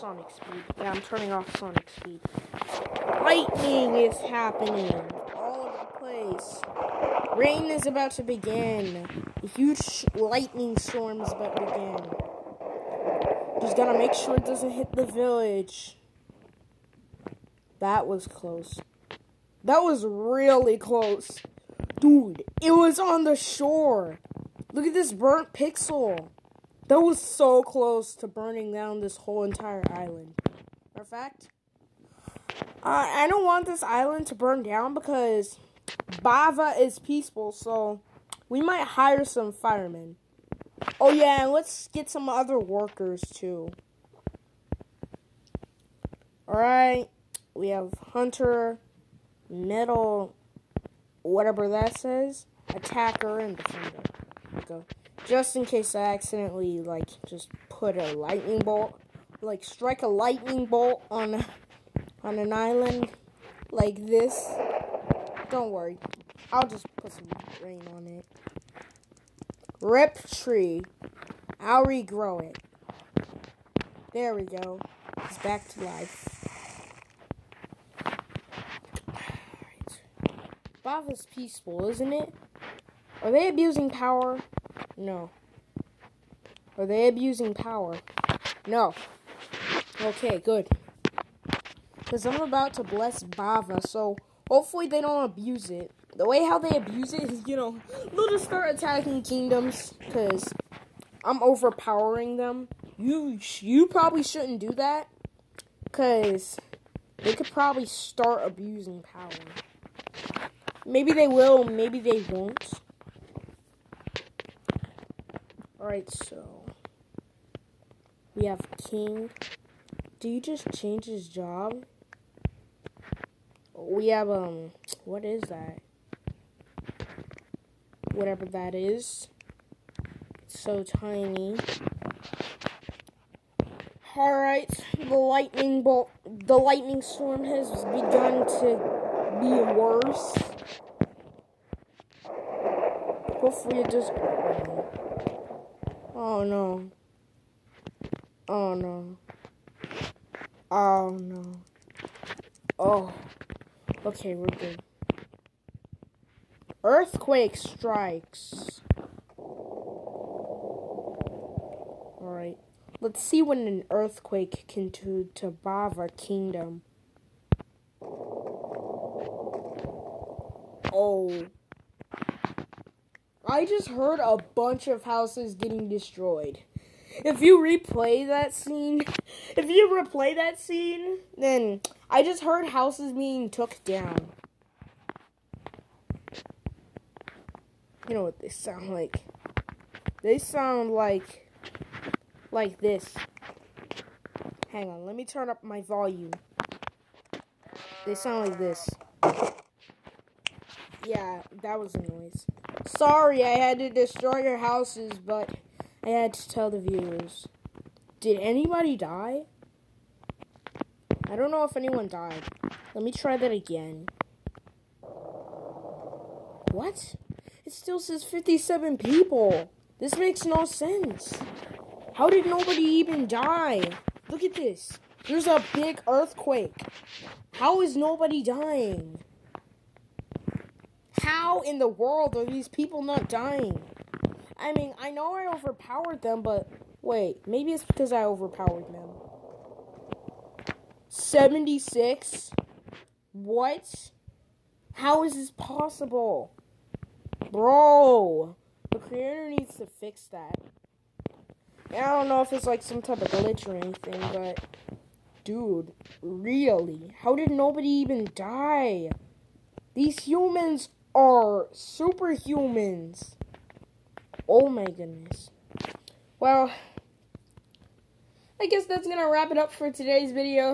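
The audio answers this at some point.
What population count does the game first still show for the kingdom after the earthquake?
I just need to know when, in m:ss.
3:38.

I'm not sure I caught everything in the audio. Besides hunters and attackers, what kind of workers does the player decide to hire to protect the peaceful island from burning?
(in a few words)
Firemen.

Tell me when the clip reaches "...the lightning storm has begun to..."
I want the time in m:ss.
2:16.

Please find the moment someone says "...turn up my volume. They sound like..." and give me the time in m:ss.
3:15.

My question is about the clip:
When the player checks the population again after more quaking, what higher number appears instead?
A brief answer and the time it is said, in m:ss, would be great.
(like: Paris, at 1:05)
76, at 4:01.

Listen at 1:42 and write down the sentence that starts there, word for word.
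You you probably shouldn't do that because they could probably start abusing power.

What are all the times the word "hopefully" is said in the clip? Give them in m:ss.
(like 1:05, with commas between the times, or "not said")
1:34, 2:23.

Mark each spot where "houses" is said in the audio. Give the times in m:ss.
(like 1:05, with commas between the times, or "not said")
2:55, 3:02, 3:24.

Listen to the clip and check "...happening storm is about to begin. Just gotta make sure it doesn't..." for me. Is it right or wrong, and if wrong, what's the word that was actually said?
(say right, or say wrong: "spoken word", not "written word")
wrong: "lightning", not "happening".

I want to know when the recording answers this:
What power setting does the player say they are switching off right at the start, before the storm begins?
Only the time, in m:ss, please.
0:01.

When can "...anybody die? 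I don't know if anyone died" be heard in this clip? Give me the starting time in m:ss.
3:28.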